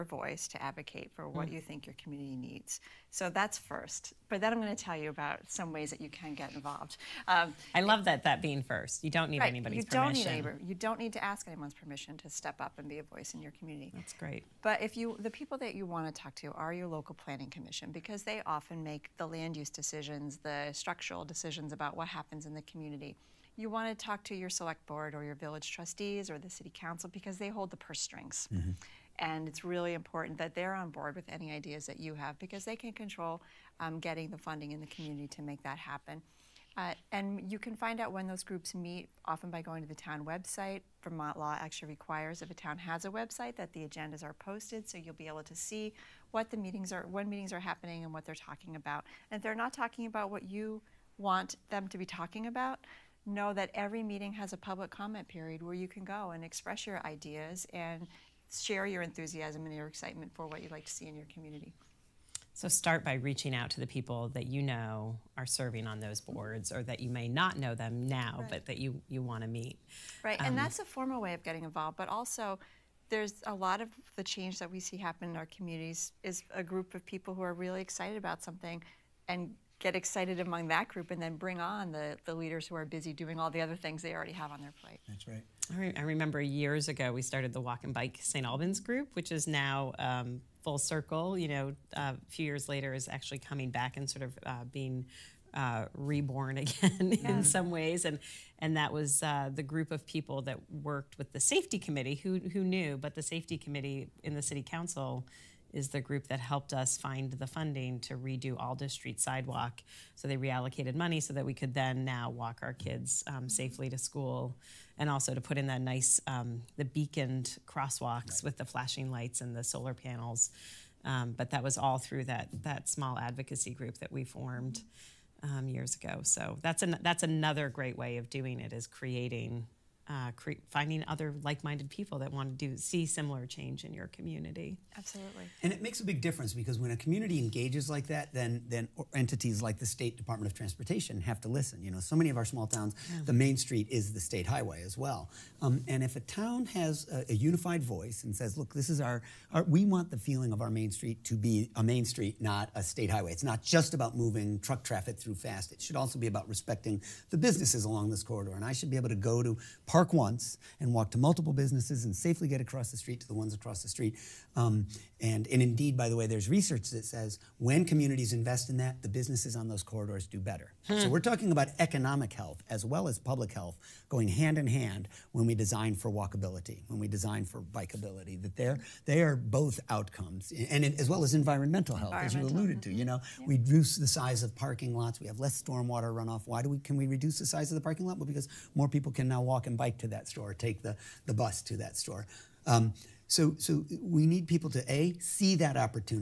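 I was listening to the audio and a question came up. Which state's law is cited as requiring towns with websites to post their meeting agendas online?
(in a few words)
Vermont.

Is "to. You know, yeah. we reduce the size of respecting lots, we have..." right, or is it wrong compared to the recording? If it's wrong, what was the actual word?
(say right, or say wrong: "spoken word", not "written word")
wrong: "parking", not "respecting".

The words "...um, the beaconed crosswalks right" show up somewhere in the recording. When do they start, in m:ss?
1:56.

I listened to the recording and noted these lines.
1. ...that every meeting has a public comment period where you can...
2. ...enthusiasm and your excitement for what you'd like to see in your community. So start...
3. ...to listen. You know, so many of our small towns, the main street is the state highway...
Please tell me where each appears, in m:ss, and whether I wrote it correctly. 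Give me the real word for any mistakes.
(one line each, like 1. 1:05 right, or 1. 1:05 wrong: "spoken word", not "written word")
1. 0:53 right
2. 0:59 right
3. 2:21 right.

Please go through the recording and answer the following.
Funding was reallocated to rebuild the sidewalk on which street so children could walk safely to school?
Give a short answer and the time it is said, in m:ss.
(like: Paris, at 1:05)
Alda Street, at 1:48.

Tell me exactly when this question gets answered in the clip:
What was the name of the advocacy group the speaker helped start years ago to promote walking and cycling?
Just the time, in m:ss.
1:27.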